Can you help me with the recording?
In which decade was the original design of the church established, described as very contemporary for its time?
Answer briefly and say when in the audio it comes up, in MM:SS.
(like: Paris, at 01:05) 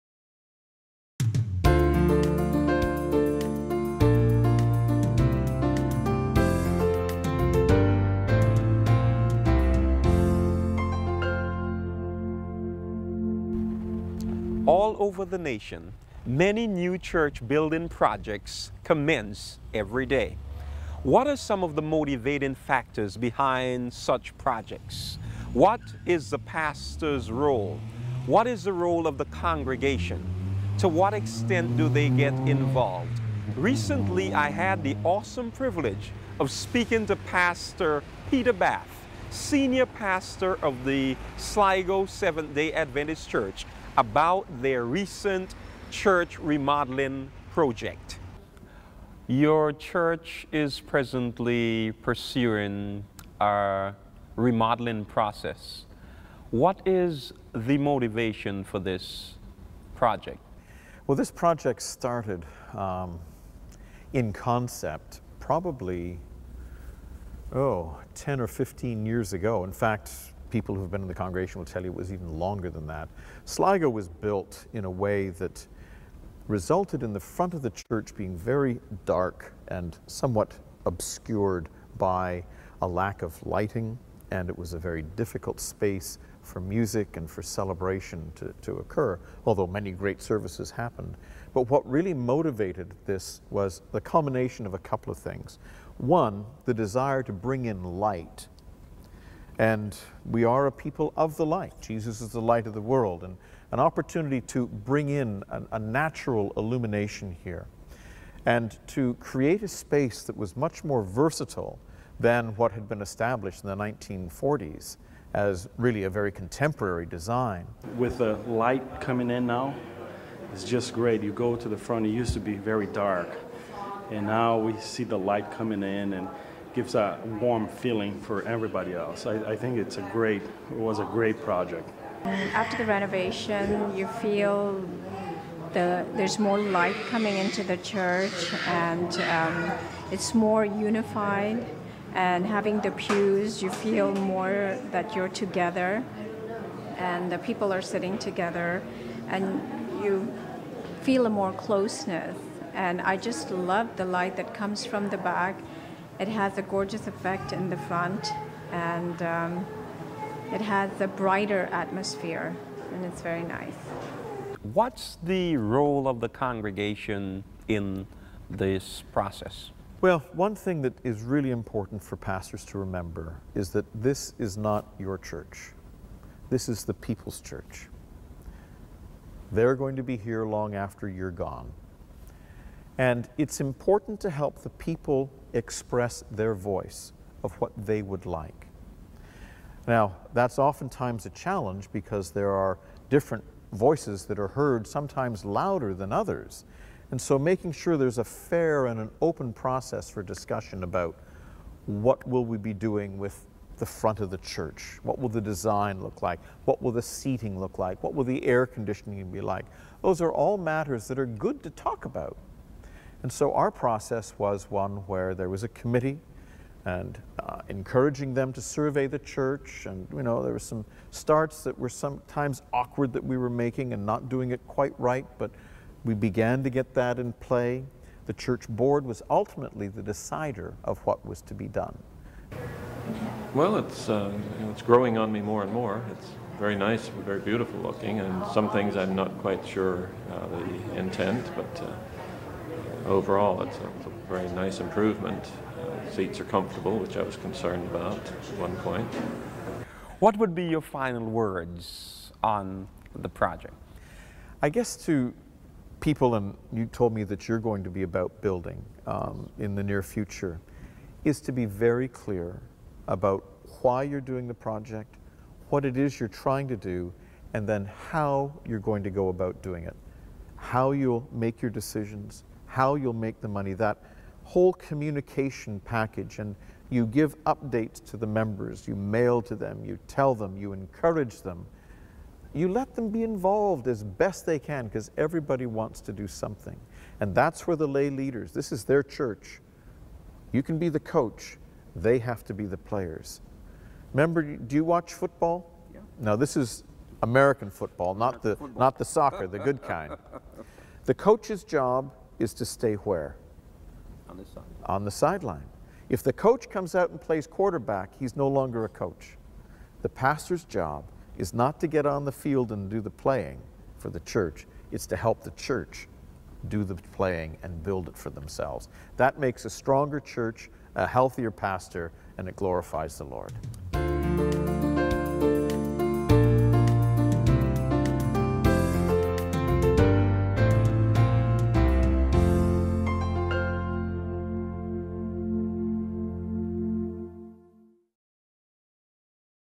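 1940s, at 01:53.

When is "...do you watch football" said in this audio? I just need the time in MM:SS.
04:54.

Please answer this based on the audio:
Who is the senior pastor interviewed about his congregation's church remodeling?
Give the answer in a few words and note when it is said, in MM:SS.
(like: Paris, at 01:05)
Peter Bath, at 00:38.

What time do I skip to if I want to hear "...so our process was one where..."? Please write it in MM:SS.
03:33.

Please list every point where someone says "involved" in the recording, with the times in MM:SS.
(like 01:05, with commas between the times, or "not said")
00:32, 04:43.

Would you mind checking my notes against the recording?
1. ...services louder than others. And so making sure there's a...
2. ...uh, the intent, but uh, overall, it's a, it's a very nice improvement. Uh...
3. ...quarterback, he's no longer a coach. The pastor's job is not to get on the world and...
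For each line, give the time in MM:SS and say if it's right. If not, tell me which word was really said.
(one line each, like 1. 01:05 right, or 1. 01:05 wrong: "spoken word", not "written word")
1. 03:14 wrong: "sometimes", not "services"
2. 04:00 right
3. 05:07 wrong: "field", not "world".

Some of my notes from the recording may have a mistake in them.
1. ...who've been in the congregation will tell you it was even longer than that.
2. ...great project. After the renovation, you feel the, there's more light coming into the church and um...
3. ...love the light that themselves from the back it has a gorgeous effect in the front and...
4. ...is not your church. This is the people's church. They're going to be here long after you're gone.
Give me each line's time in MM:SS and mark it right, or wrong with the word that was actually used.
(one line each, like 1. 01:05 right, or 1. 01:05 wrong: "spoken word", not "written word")
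1. 01:10 right
2. 02:11 right
3. 02:33 wrong: "comes", not "themselves"
4. 02:54 right.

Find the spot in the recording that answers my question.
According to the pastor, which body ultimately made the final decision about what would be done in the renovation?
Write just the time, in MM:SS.
03:48.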